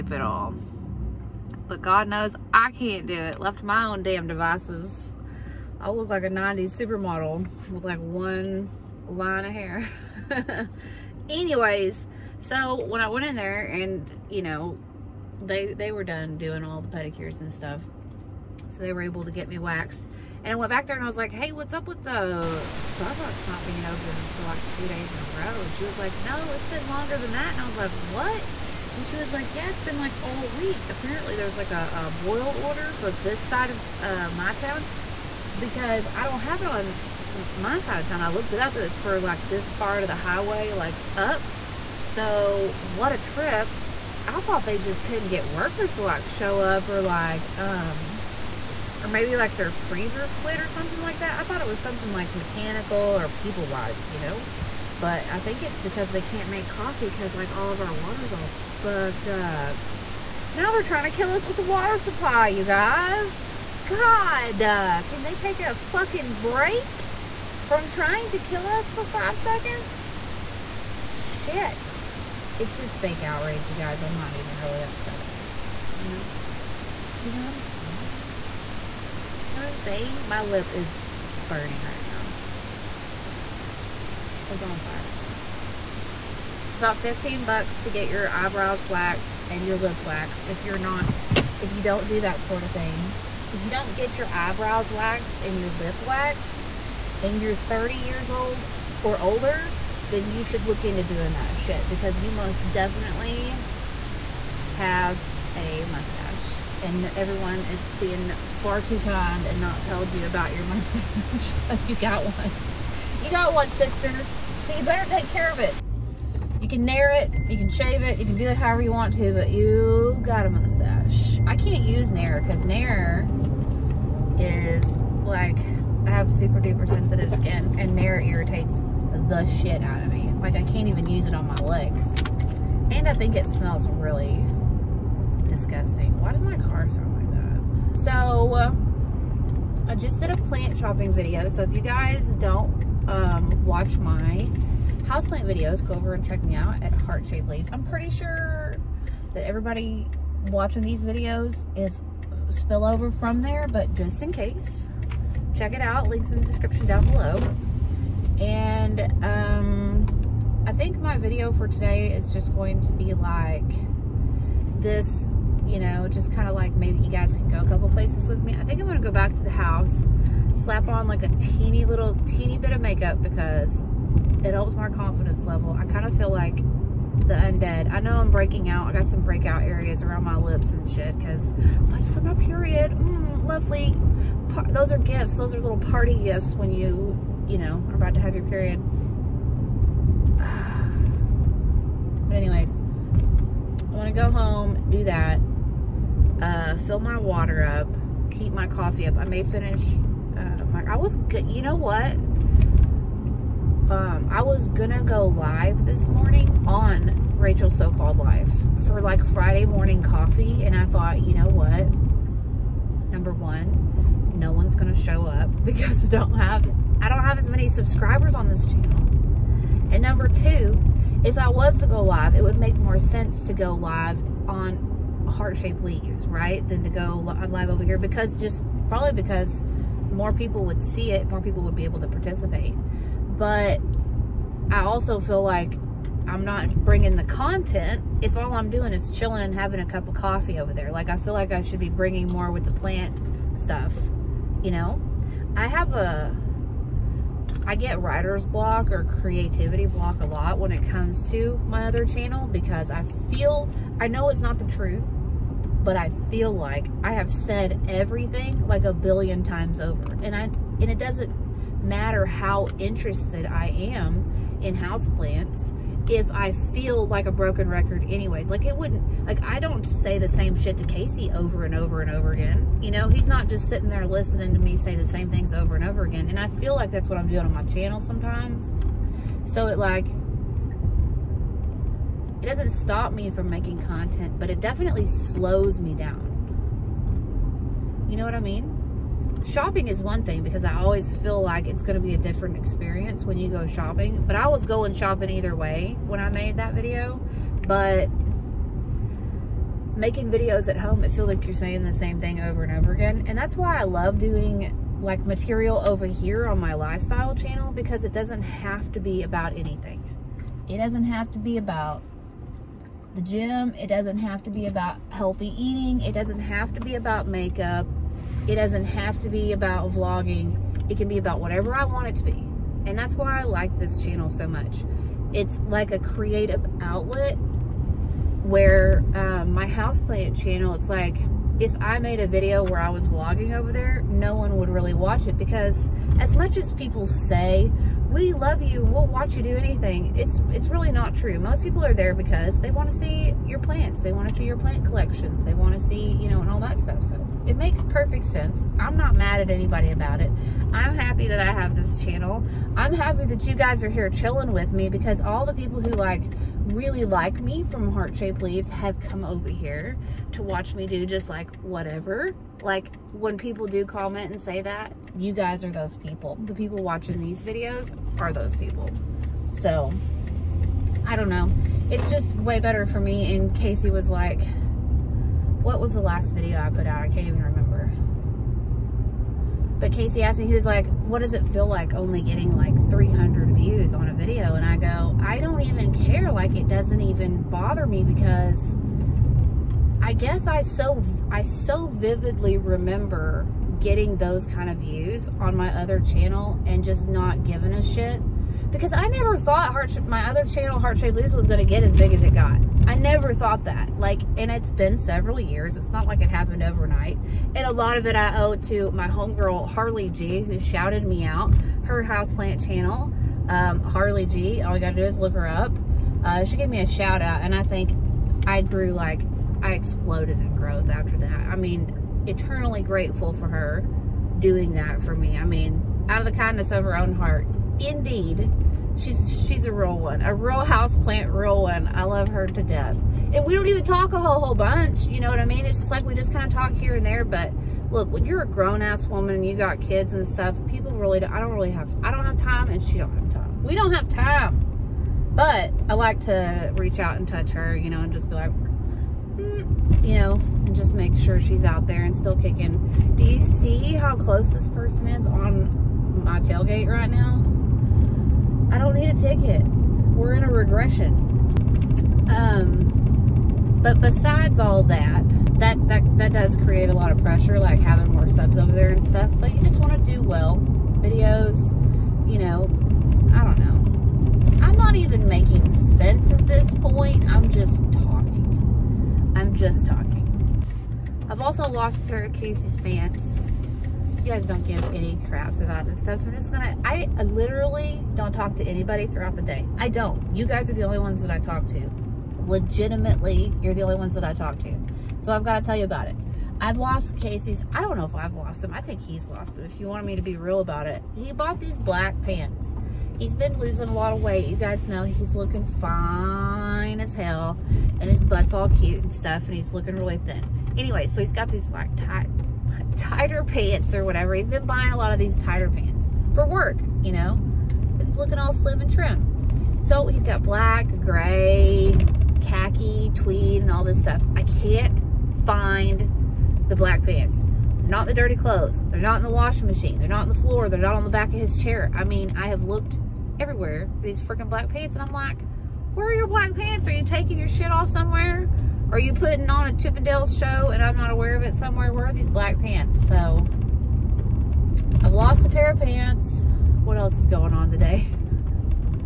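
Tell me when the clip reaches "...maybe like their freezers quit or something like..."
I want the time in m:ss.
0:49.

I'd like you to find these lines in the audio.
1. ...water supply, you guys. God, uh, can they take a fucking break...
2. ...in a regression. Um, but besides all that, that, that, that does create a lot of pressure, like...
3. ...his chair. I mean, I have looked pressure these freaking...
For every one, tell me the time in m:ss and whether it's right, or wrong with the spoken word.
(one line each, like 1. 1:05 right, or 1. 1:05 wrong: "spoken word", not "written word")
1. 1:01 right
2. 7:40 right
3. 8:51 wrong: "everywhere", not "pressure".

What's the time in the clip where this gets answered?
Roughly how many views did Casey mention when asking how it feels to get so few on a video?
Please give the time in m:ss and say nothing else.
6:22.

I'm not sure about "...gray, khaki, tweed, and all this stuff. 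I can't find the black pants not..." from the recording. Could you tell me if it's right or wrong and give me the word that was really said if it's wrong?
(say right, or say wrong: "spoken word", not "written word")
right.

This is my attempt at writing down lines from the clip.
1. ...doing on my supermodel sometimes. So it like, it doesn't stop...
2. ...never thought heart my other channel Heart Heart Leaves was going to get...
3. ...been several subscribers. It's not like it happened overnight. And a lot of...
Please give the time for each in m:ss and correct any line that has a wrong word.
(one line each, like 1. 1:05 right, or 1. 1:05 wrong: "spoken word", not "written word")
1. 4:37 wrong: "channel", not "supermodel"
2. 6:39 wrong: "Shaped", not "Heart"
3. 6:44 wrong: "years", not "subscribers".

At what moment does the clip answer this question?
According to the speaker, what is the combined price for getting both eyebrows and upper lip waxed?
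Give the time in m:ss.
1:27.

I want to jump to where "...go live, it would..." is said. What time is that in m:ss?
3:41.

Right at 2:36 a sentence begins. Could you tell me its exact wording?
Links in the description down below.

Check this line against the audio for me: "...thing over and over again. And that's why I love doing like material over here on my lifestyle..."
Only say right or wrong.
right.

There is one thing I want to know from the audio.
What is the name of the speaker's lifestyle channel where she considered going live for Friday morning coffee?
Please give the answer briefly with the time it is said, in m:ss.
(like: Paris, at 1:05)
Rachel's So Called Life, at 3:27.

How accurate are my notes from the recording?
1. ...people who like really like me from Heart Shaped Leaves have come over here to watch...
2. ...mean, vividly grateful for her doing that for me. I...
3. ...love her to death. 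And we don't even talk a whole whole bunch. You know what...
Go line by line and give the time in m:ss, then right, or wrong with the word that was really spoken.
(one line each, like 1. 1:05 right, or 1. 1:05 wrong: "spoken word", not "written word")
1. 5:55 right
2. 7:01 wrong: "eternally", not "vividly"
3. 7:12 right.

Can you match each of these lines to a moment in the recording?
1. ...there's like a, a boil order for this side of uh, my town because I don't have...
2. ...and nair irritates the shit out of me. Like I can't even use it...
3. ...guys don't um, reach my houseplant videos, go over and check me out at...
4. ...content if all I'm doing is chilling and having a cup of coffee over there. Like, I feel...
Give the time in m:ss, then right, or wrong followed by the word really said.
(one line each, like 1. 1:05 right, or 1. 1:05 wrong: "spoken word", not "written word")
1. 0:31 right
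2. 2:07 right
3. 2:21 wrong: "watch", not "reach"
4. 3:57 right.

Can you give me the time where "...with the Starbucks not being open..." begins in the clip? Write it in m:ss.
0:21.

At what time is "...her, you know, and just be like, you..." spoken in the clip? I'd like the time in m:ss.
7:27.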